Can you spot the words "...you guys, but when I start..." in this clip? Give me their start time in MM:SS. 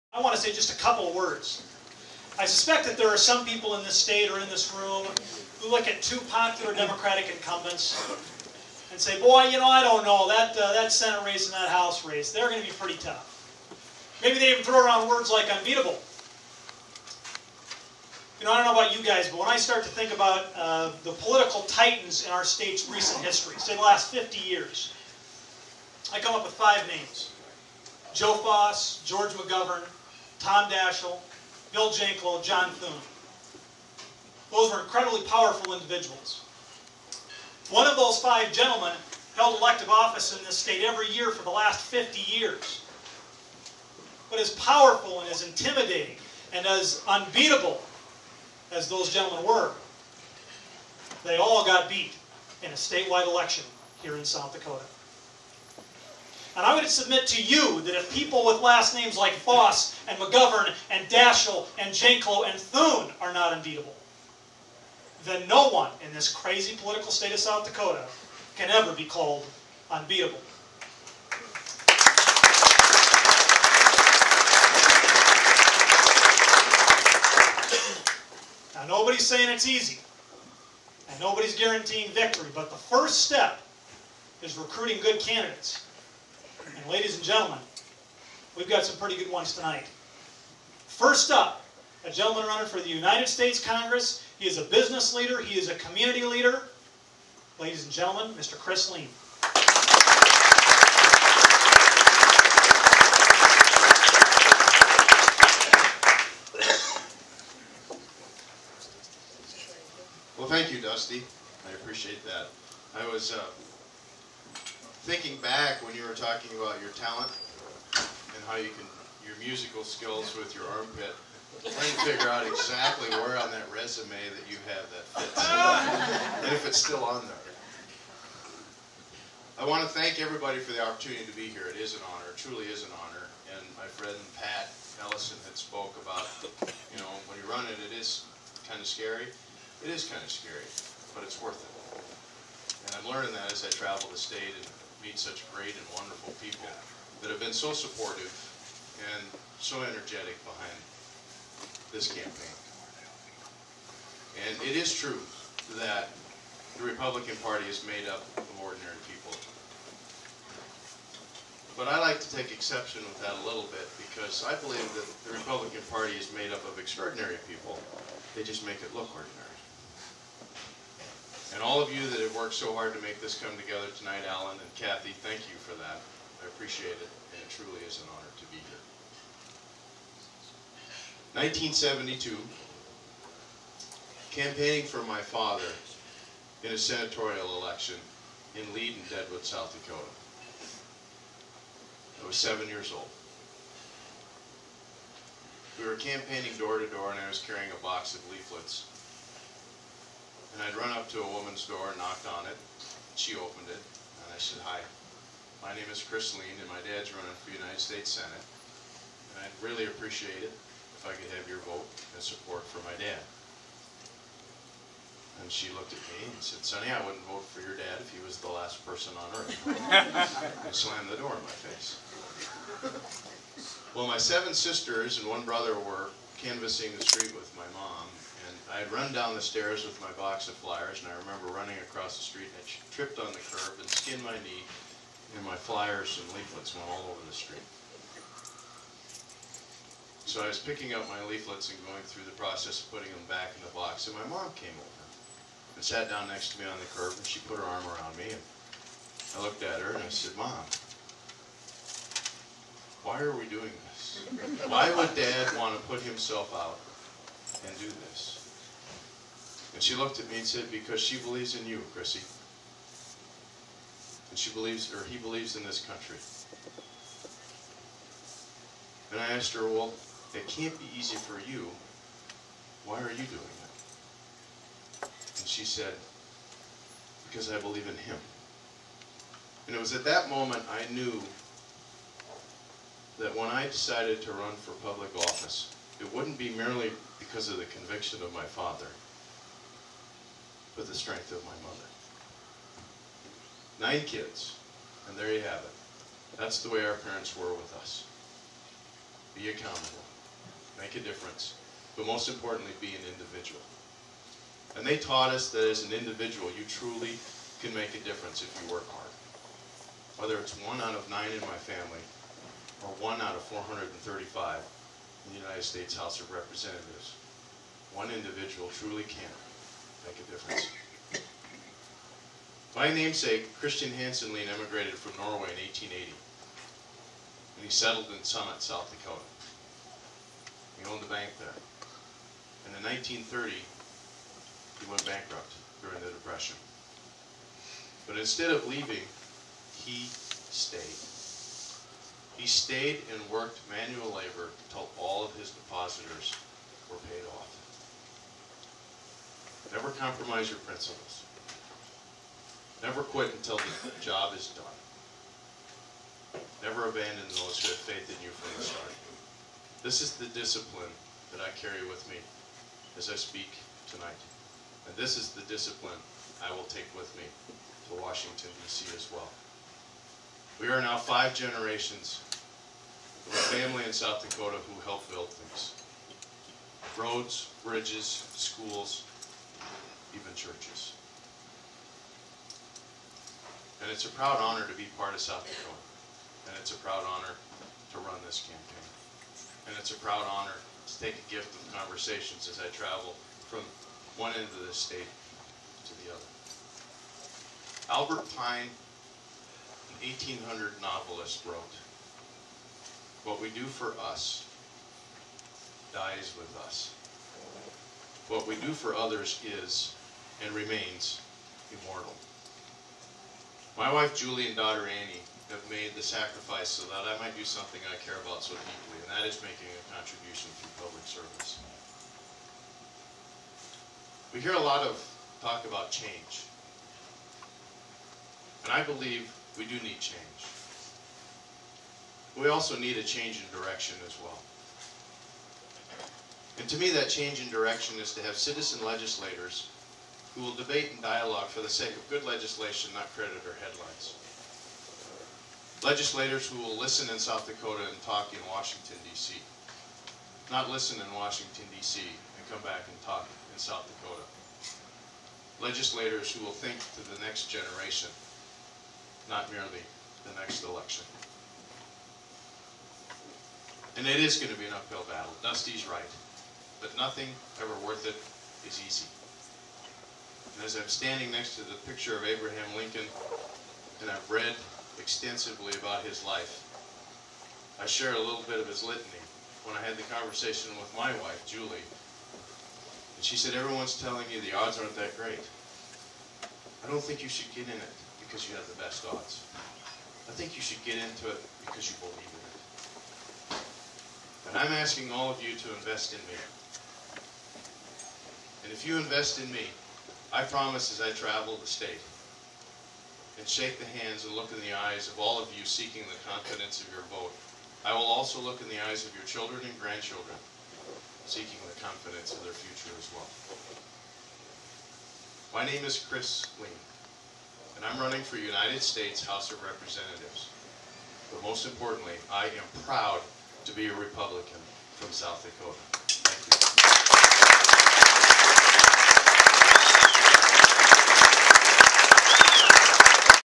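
00:18.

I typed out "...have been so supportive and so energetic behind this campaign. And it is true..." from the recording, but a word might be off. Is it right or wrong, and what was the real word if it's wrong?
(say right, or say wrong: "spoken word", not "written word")
right.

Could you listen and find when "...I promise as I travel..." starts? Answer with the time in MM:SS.
08:20.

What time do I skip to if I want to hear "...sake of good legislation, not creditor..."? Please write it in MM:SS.
07:21.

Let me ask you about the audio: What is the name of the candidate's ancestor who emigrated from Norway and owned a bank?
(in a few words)
Christian Hansenlein.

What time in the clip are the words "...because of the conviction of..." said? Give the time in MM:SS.
04:47.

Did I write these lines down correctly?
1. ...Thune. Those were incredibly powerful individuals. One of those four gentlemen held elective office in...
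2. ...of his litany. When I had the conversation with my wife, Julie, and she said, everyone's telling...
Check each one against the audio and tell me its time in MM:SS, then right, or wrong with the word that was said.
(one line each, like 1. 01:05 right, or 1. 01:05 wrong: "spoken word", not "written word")
1. 00:32 wrong: "five", not "four"
2. 07:58 right.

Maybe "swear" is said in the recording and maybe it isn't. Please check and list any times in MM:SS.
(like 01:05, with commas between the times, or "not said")
not said.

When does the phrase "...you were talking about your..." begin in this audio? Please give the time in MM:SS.
01:55.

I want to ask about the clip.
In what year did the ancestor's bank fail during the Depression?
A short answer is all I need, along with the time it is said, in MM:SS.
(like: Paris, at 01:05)
1930, at 05:32.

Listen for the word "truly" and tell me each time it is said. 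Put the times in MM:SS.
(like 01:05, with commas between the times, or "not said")
02:12, 02:57, 05:06, 05:18.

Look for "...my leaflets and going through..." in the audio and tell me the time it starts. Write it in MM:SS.
04:01.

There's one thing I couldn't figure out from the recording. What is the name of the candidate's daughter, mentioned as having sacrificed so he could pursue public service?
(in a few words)
Annie.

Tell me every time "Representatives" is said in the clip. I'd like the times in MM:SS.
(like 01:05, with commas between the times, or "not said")
05:16, 08:39.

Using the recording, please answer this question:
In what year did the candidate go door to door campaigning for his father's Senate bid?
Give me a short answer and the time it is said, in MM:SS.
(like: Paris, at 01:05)
1972, at 03:01.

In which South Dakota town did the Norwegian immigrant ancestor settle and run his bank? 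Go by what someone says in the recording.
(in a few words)
Summit.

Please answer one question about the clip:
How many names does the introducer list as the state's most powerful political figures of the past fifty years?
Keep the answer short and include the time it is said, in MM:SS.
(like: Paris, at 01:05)
5, at 00:26.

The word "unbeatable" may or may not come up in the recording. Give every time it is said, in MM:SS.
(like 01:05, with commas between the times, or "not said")
00:15, 00:47, 01:03, 01:09.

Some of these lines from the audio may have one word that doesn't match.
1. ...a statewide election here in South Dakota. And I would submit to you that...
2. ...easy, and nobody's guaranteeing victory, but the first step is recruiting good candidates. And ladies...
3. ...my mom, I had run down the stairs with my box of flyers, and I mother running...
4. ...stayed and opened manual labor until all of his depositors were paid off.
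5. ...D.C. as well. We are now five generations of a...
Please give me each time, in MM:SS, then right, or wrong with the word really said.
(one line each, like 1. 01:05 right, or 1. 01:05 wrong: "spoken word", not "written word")
1. 00:52 right
2. 01:19 right
3. 03:47 wrong: "remember", not "mother"
4. 05:42 wrong: "worked", not "opened"
5. 06:08 right.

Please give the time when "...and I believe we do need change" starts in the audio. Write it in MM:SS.
07:08.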